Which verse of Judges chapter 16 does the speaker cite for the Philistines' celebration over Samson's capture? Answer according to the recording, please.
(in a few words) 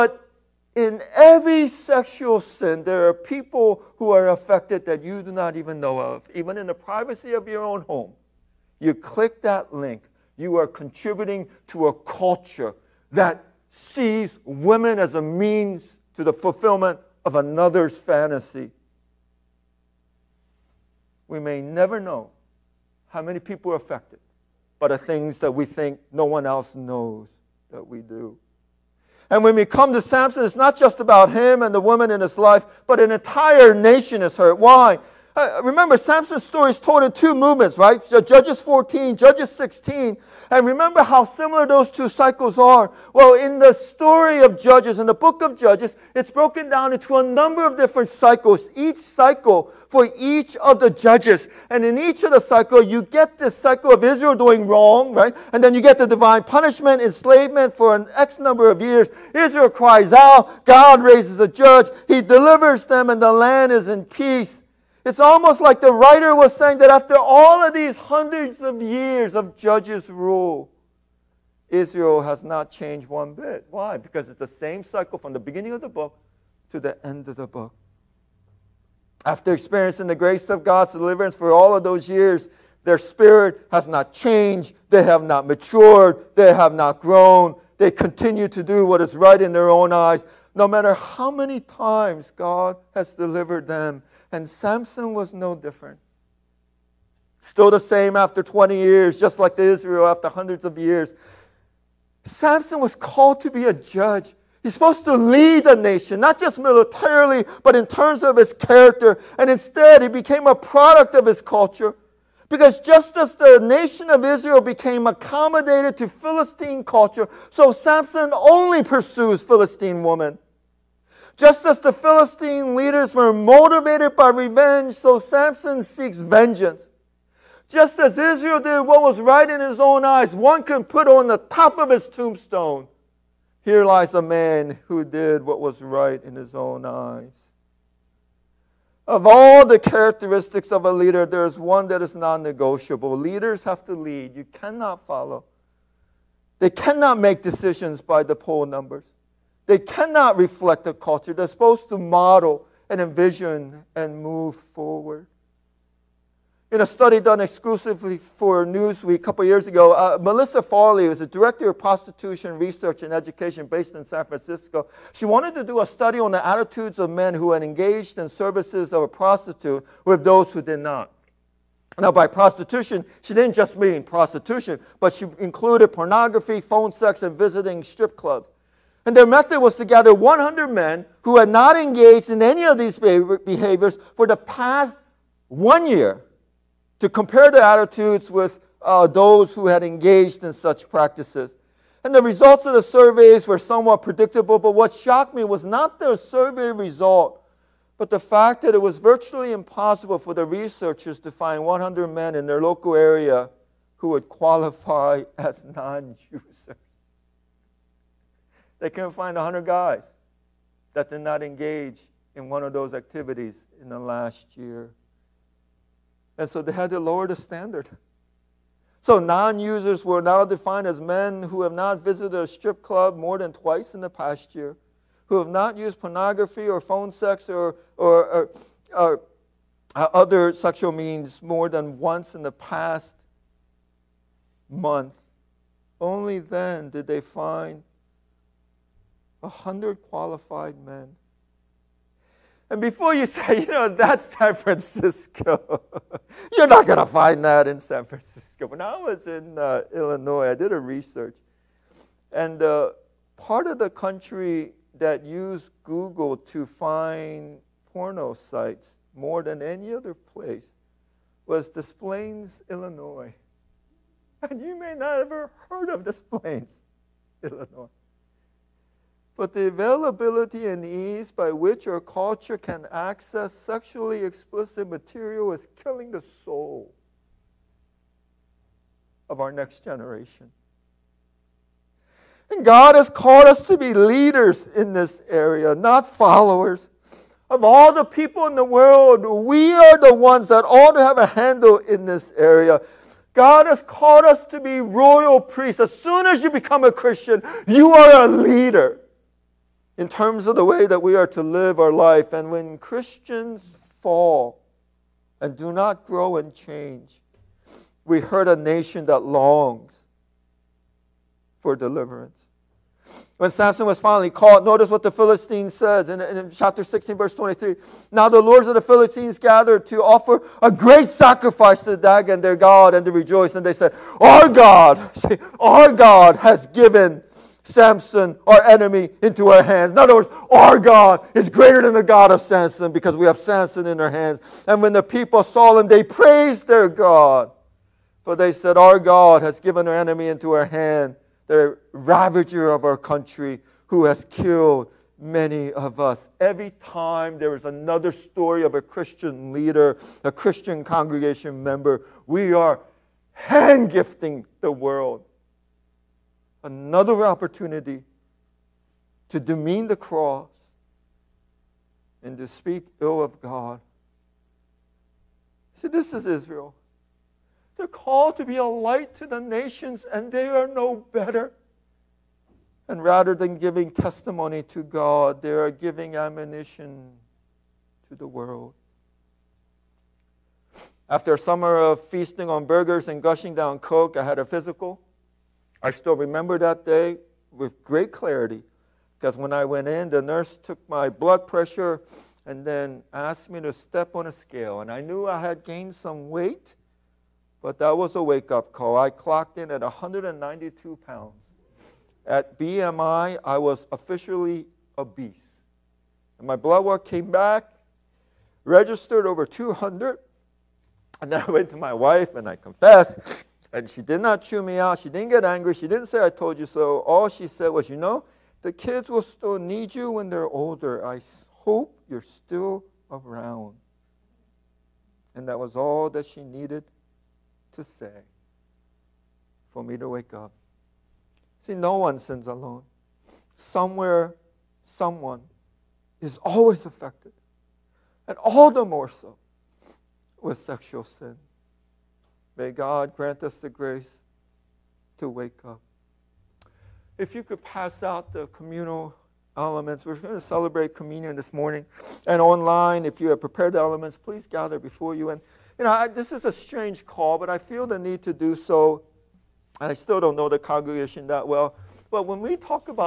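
Verse 23.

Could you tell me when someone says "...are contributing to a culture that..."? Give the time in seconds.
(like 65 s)
10 s.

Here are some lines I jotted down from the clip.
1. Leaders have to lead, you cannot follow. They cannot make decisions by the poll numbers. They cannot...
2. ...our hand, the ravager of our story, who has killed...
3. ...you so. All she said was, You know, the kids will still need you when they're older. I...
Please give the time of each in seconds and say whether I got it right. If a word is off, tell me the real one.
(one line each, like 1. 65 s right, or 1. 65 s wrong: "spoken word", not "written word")
1. 143 s right
2. 340 s wrong: "country", not "story"
3. 416 s right.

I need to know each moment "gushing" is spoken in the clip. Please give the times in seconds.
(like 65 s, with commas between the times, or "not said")
383 s.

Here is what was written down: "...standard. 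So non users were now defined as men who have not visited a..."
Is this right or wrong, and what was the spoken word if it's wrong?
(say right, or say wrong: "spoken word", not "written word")
right.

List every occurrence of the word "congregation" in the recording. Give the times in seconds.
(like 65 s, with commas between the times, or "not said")
350 s, 460 s.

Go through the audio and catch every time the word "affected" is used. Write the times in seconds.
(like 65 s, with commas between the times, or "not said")
4 s, 23 s, 436 s.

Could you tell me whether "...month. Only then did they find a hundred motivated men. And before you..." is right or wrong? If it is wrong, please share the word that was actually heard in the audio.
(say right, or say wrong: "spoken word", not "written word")
wrong: "qualified", not "motivated".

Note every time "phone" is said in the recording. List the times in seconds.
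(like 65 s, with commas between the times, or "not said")
176 s, 226 s.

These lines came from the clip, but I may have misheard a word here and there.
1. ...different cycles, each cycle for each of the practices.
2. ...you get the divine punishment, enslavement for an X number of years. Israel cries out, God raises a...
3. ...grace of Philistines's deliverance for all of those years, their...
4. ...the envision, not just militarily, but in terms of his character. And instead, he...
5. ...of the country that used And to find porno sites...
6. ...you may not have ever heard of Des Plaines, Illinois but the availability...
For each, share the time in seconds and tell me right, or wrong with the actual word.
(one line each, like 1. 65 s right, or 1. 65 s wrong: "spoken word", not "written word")
1. 47 s wrong: "judges", not "practices"
2. 55 s right
3. 80 s wrong: "God", not "Philistines"
4. 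105 s wrong: "nation", not "envision"
5. 253 s wrong: "Google", not "And"
6. 264 s right.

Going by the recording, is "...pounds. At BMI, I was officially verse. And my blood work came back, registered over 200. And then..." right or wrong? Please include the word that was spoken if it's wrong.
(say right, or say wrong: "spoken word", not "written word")
wrong: "obese", not "verse".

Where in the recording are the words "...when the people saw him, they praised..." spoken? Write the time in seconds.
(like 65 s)
334 s.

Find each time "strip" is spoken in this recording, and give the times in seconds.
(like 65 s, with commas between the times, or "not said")
177 s, 222 s.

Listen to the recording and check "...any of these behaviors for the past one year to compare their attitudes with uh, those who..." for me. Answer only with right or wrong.
right.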